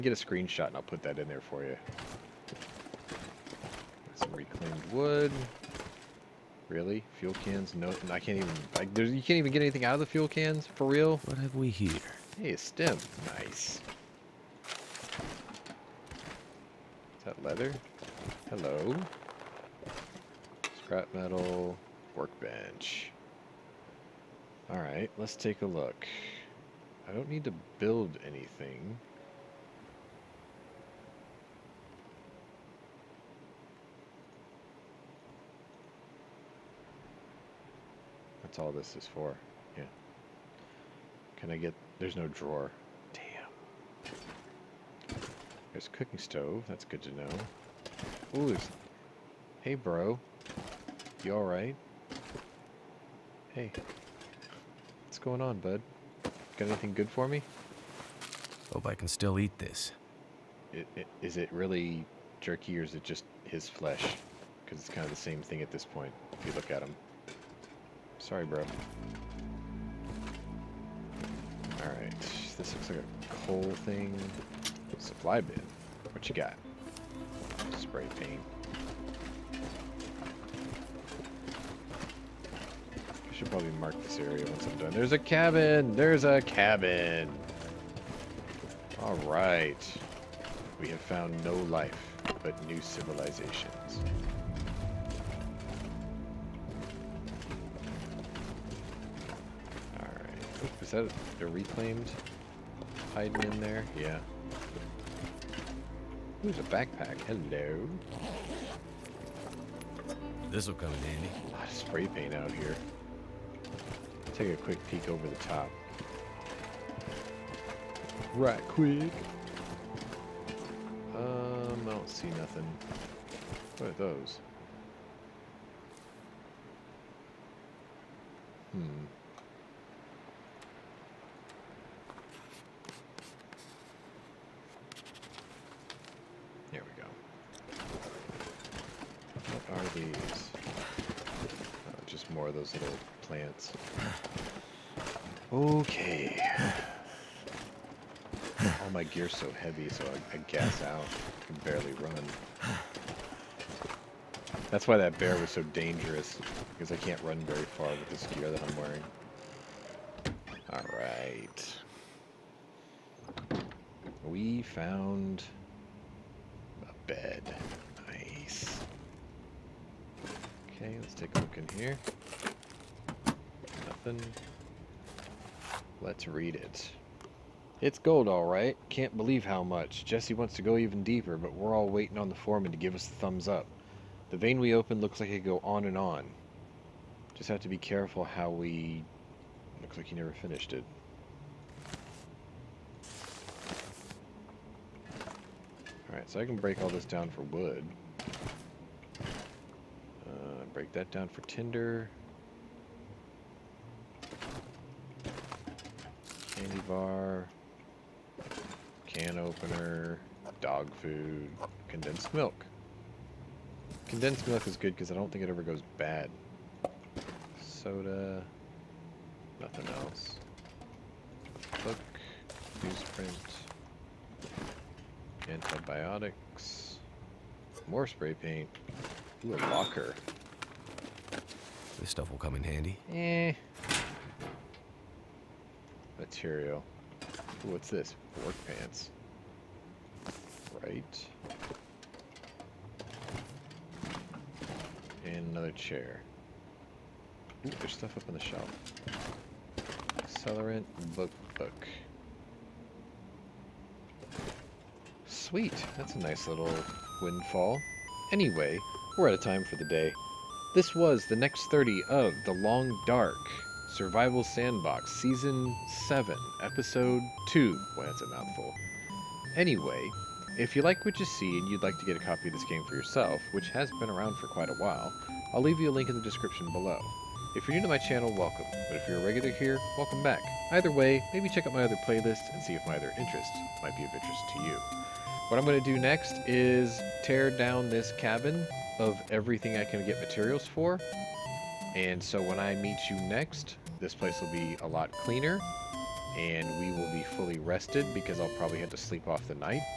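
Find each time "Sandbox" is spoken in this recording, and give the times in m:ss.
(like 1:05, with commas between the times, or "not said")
4:24.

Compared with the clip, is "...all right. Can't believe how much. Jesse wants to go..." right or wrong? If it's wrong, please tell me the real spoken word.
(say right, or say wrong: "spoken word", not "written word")
right.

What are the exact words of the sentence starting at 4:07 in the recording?
Ooh, there's stuff up on the shelf.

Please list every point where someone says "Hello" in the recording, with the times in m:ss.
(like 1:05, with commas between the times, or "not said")
0:18, 1:47.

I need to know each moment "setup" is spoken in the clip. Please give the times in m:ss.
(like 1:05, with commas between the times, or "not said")
not said.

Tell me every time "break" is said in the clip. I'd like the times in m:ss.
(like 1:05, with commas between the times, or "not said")
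3:16, 3:20.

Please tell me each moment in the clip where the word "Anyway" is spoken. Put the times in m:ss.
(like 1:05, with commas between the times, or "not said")
4:18, 4:29.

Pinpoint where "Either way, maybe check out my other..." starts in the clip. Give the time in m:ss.
4:40.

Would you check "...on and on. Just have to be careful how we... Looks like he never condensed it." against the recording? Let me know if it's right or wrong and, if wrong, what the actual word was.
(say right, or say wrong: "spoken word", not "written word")
wrong: "finished", not "condensed".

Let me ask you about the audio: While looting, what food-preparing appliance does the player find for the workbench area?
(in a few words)
Cooking stove.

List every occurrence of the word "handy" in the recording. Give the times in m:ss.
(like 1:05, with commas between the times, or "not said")
1:51, 3:52.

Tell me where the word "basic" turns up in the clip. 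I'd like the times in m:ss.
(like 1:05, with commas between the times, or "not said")
not said.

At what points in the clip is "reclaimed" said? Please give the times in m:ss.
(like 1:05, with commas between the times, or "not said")
0:04, 1:41.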